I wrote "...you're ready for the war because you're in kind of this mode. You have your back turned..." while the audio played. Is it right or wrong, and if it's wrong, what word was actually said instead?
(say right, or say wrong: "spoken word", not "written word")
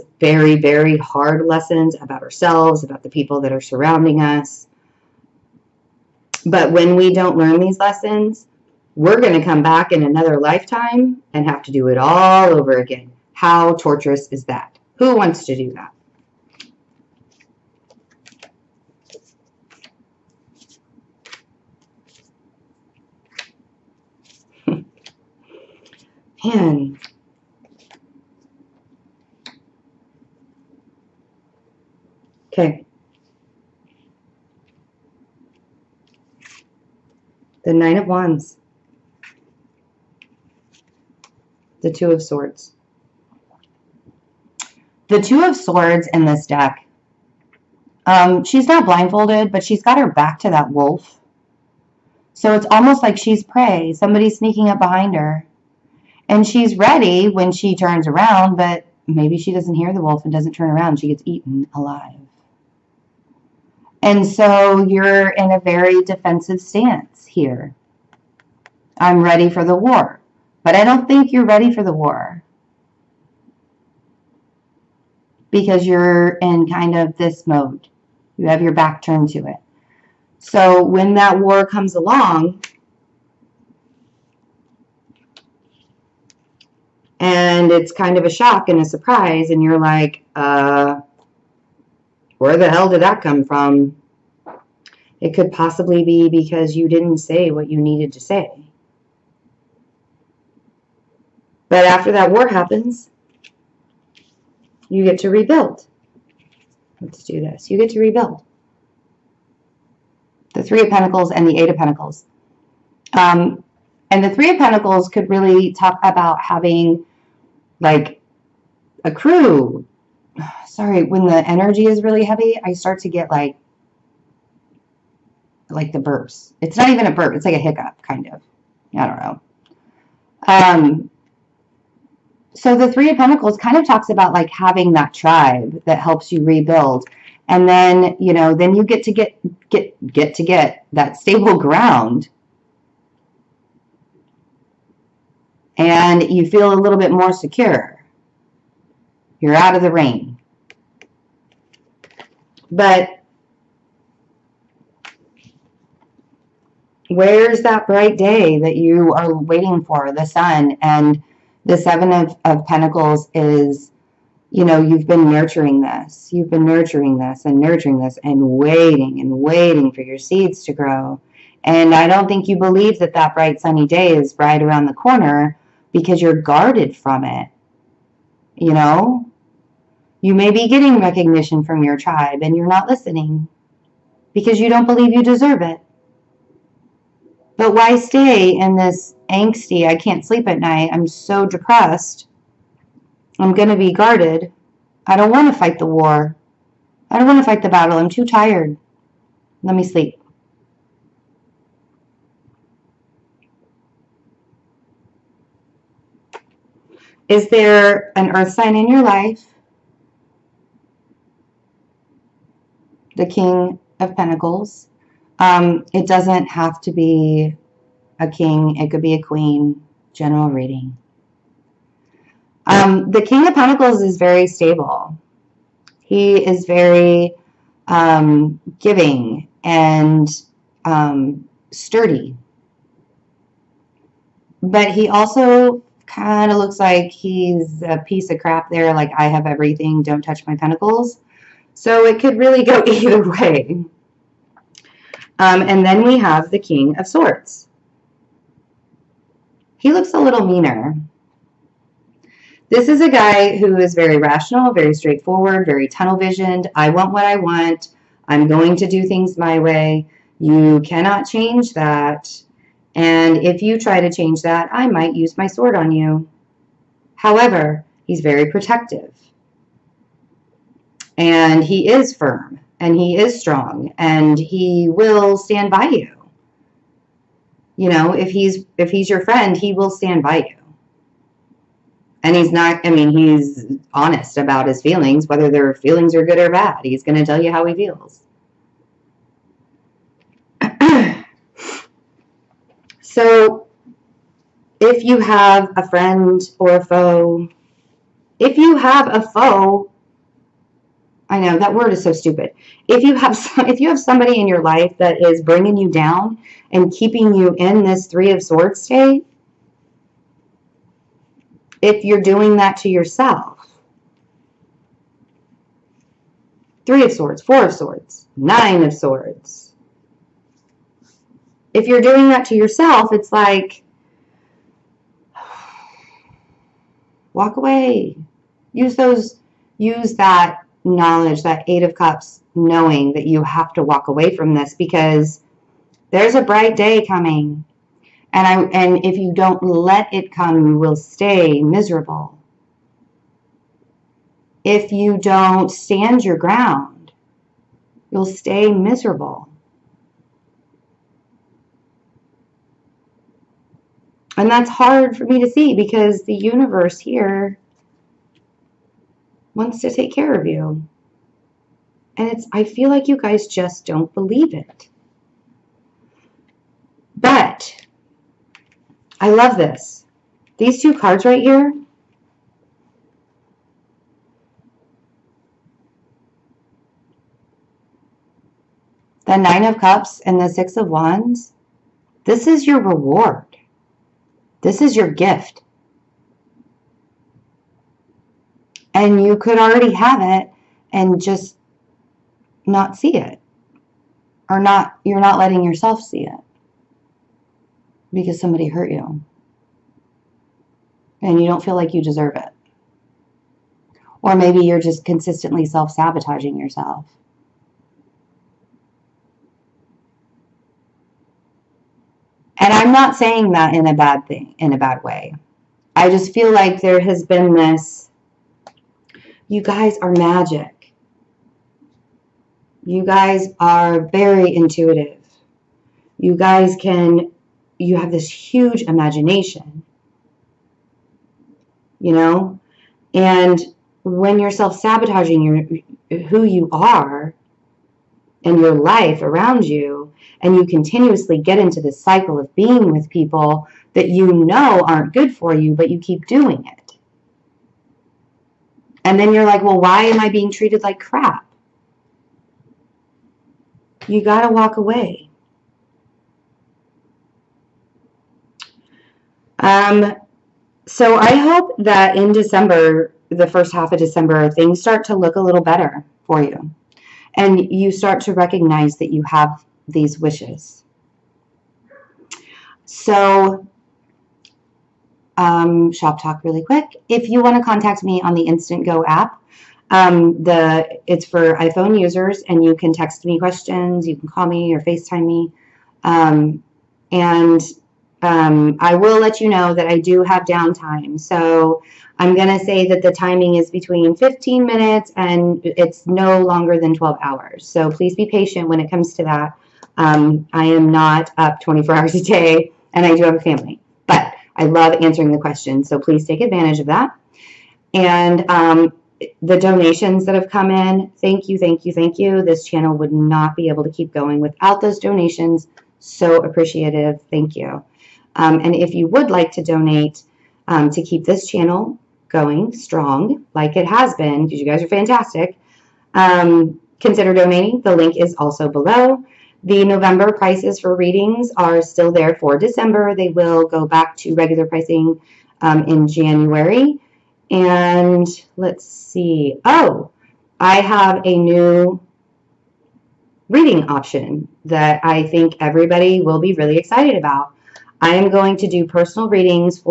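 right.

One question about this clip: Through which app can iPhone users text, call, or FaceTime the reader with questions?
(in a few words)
InstantGo.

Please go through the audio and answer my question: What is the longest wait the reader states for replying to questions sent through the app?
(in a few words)
12 hours.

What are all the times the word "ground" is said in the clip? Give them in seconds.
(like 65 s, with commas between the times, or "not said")
141 s, 346 s.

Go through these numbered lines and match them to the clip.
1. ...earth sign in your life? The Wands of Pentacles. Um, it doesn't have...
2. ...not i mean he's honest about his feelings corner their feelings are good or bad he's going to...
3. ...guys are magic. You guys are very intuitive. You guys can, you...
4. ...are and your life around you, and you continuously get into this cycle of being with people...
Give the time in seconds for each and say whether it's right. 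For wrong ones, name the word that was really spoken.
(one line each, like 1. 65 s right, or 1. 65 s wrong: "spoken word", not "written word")
1. 208 s wrong: "King", not "Wands"
2. 282 s wrong: "whether", not "corner"
3. 419 s right
4. 436 s right.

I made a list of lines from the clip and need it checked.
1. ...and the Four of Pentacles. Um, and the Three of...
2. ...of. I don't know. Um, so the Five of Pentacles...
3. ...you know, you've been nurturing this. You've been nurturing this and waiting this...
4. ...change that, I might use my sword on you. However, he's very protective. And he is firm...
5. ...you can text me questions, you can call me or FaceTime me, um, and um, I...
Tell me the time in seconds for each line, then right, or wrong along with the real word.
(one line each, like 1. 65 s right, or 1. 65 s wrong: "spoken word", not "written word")
1. 111 s wrong: "Eight", not "Four"
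2. 128 s wrong: "Three", not "Five"
3. 164 s wrong: "nurturing", not "waiting"
4. 264 s right
5. 482 s right.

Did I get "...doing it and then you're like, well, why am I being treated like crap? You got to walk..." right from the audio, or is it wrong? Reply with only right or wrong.
right.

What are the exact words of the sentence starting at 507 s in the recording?
And um, the donations that have come in, thank you, thank you, thank you.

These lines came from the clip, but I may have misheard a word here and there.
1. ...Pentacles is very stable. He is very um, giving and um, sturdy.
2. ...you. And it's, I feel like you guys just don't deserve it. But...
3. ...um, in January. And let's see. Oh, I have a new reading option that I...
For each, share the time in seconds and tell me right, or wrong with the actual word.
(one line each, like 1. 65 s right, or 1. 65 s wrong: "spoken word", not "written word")
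1. 223 s right
2. 360 s wrong: "believe", not "deserve"
3. 535 s right.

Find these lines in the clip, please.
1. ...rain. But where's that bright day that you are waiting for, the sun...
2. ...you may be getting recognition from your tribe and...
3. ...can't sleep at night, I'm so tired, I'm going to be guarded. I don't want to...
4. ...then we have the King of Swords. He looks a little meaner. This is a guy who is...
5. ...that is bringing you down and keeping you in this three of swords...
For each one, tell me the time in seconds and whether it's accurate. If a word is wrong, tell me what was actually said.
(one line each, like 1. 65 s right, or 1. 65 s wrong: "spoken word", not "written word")
1. 149 s right
2. 180 s right
3. 189 s wrong: "depressed", not "tired"
4. 245 s right
5. 304 s right.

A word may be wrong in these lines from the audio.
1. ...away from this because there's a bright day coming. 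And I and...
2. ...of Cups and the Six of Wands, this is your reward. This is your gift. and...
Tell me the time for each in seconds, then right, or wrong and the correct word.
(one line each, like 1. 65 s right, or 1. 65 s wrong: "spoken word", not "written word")
1. 334 s right
2. 379 s right.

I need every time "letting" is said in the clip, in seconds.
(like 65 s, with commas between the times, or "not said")
395 s.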